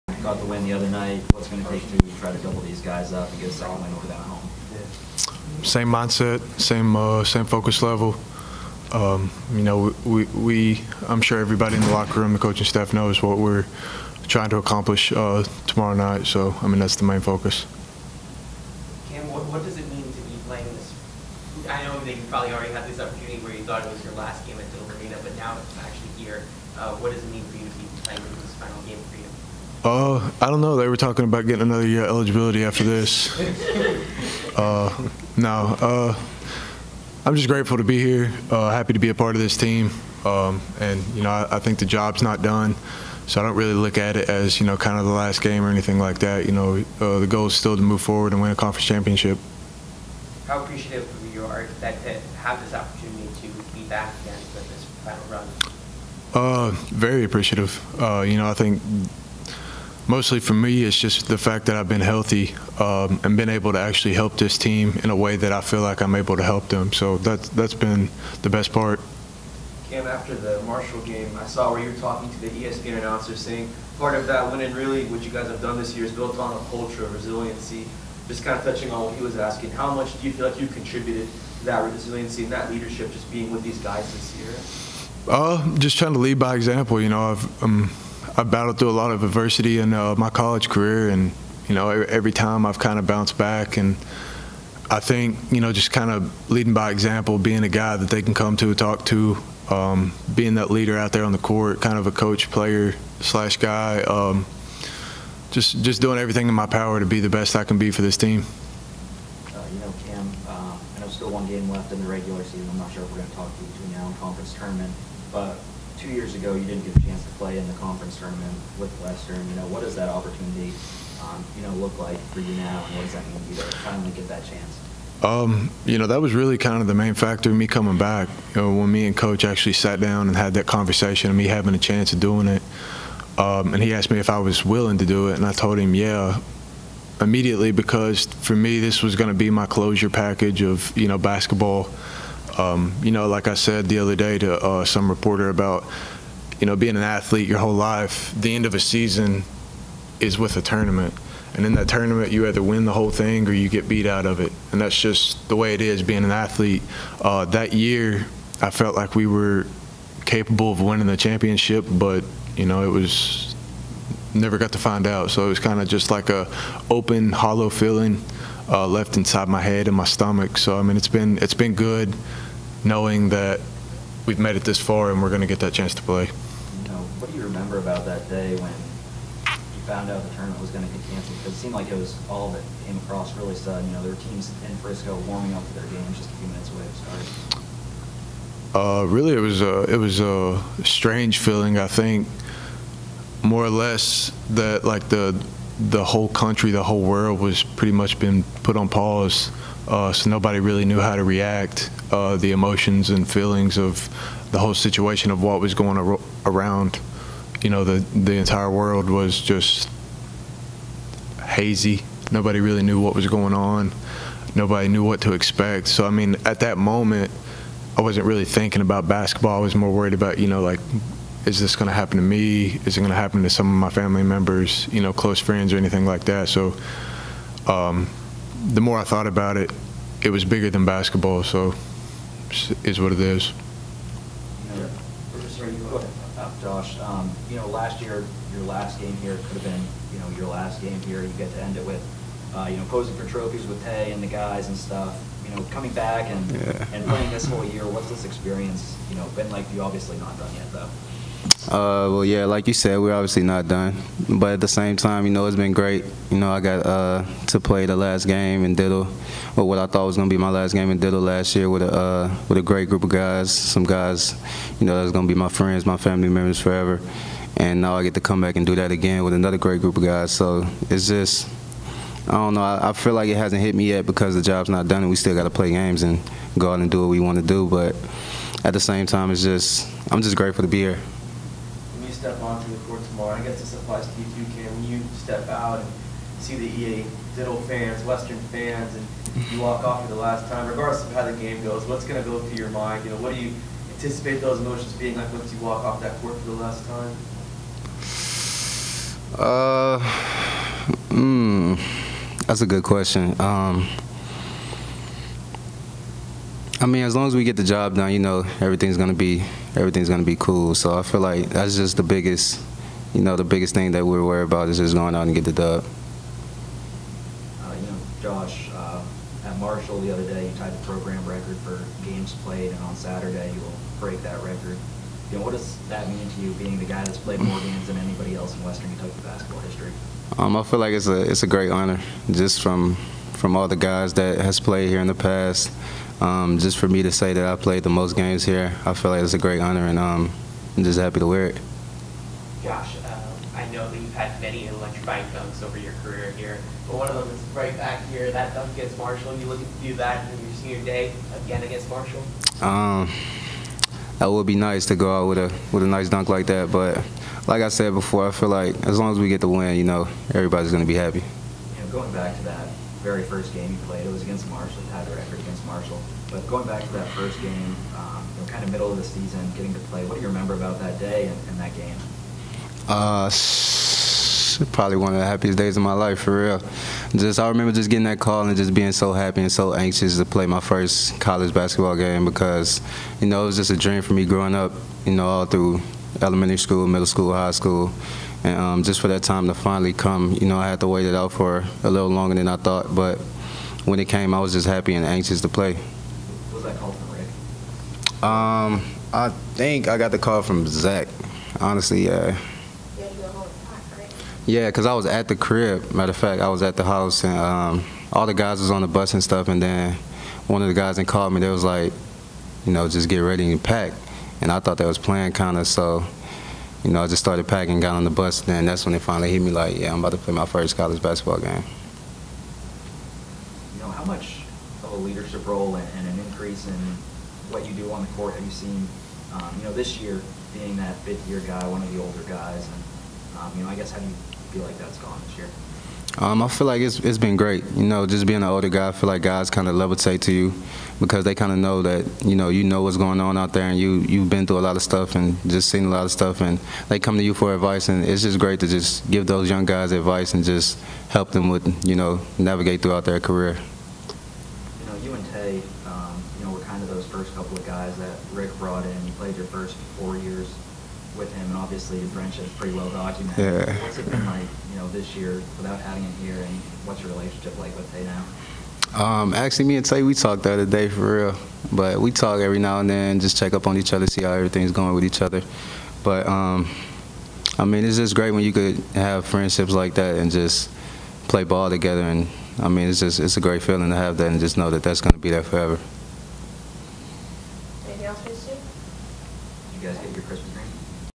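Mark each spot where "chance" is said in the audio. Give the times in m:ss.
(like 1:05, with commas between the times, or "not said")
1:57, 2:04, 2:11, 2:55.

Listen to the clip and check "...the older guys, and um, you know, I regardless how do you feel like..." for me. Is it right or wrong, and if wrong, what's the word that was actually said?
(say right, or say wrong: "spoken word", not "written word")
wrong: "guess", not "regardless".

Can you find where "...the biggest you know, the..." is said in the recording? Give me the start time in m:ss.
5:11.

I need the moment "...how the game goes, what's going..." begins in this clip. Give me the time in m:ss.
4:51.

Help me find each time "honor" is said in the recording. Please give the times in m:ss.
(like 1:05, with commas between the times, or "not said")
5:31, 5:39.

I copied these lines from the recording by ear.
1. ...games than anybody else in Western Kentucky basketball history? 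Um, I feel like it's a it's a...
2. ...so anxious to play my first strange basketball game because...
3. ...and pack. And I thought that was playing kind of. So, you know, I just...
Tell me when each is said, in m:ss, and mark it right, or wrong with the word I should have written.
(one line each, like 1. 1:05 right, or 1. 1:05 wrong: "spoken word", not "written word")
1. 5:27 right
2. 6:19 wrong: "college", not "strange"
3. 6:53 right.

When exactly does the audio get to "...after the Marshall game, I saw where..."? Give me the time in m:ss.
1:10.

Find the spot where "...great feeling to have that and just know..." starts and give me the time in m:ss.
8:03.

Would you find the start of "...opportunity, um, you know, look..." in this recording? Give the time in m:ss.
2:00.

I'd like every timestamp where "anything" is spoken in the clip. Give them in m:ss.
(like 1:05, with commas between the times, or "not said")
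0:45, 3:45.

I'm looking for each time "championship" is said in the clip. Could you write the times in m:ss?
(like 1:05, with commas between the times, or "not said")
0:48, 2:41.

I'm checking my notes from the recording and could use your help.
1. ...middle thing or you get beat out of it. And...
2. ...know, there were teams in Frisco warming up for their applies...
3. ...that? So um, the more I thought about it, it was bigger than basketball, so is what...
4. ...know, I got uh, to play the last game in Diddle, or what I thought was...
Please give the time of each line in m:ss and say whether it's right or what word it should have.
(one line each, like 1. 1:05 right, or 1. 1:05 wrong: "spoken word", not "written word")
1. 2:32 wrong: "whole", not "middle"
2. 3:03 wrong: "games", not "applies"
3. 3:46 right
4. 4:16 right.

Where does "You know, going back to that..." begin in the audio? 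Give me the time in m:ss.
6:01.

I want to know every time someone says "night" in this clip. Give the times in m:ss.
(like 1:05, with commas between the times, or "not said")
0:00, 0:15.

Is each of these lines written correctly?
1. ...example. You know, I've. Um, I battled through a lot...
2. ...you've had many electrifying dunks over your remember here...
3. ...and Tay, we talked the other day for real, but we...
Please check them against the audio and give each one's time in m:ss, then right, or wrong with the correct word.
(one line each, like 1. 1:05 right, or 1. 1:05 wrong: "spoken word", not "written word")
1. 1:26 right
2. 5:44 wrong: "career", not "remember"
3. 7:49 right.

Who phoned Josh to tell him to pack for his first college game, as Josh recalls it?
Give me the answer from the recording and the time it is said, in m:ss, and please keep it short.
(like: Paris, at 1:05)
Zach, at 6:40.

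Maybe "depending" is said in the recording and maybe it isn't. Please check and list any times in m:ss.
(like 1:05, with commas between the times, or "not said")
not said.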